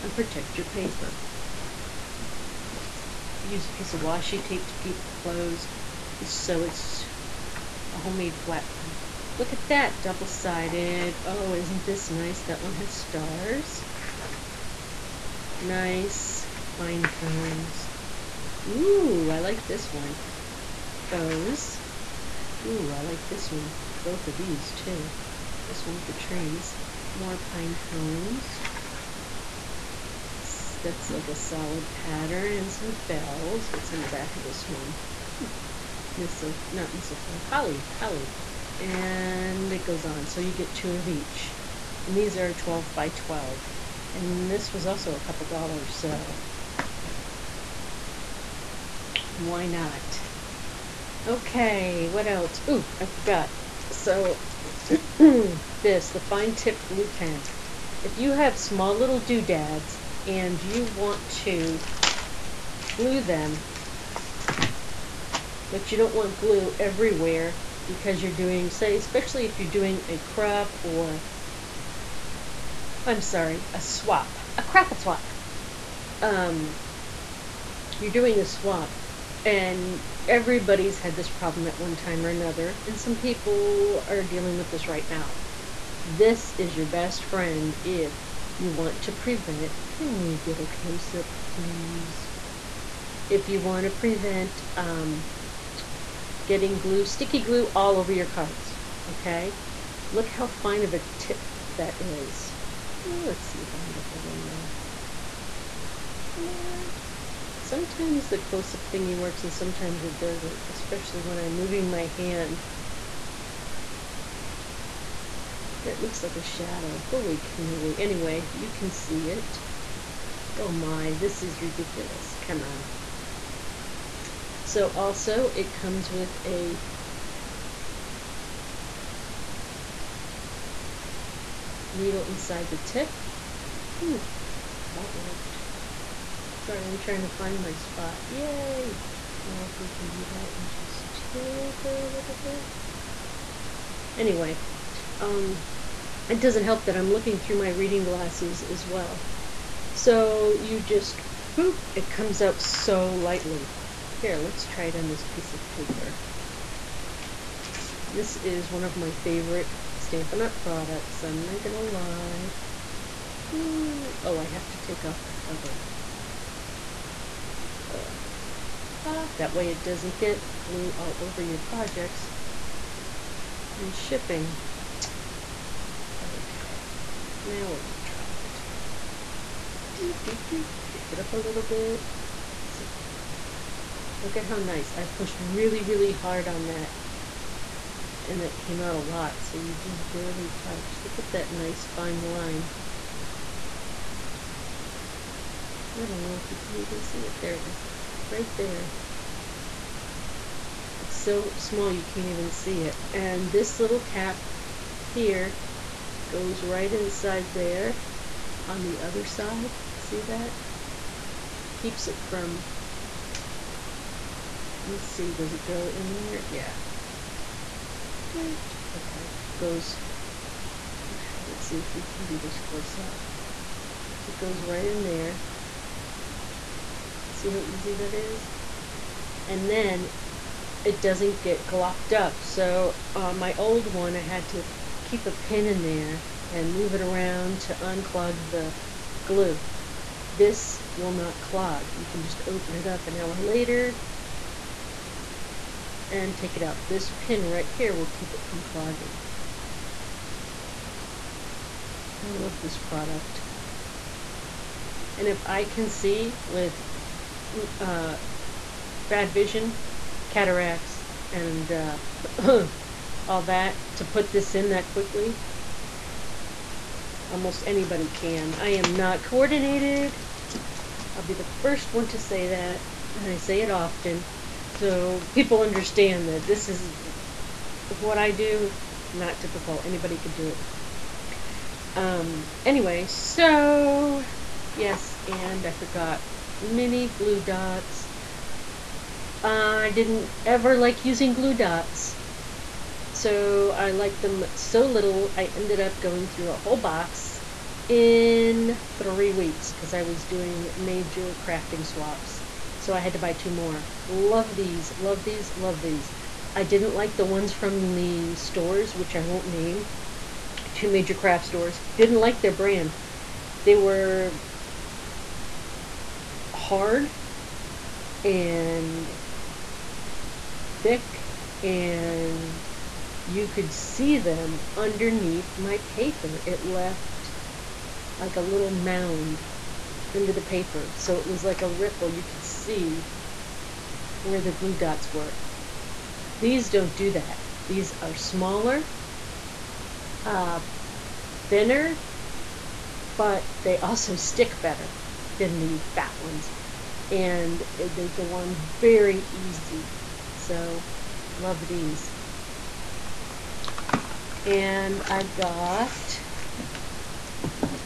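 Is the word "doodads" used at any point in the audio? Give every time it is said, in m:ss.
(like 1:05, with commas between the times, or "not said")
0:59.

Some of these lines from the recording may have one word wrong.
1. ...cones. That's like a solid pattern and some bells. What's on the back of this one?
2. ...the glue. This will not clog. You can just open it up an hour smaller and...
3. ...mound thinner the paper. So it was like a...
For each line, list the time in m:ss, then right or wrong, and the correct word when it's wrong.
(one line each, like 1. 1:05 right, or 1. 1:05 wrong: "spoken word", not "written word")
1. 0:27 right
2. 3:58 wrong: "later", not "smaller"
3. 5:28 wrong: "under", not "thinner".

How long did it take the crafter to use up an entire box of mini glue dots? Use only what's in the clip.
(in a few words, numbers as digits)
3 weeks.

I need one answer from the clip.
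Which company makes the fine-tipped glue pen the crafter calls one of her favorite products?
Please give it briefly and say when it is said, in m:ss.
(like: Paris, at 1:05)
Stampin' Up!, at 2:39.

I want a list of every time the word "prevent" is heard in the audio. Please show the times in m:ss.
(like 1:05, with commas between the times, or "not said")
1:29, 1:33.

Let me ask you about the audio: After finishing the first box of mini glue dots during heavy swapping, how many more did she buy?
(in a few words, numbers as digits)
2.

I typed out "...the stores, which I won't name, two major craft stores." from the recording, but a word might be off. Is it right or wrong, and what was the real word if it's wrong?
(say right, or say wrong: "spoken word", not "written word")
right.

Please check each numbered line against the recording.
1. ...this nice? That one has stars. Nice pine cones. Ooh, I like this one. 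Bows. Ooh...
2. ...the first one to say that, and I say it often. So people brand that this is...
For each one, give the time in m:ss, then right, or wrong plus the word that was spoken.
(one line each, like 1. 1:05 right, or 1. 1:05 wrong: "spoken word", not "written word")
1. 0:11 right
2. 4:31 wrong: "understand", not "brand".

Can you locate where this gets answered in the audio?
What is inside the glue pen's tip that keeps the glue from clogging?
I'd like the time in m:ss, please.
2:11.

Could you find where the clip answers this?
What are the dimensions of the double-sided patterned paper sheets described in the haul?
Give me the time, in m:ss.
0:42.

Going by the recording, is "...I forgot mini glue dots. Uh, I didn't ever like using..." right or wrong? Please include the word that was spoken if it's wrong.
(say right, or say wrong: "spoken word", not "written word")
right.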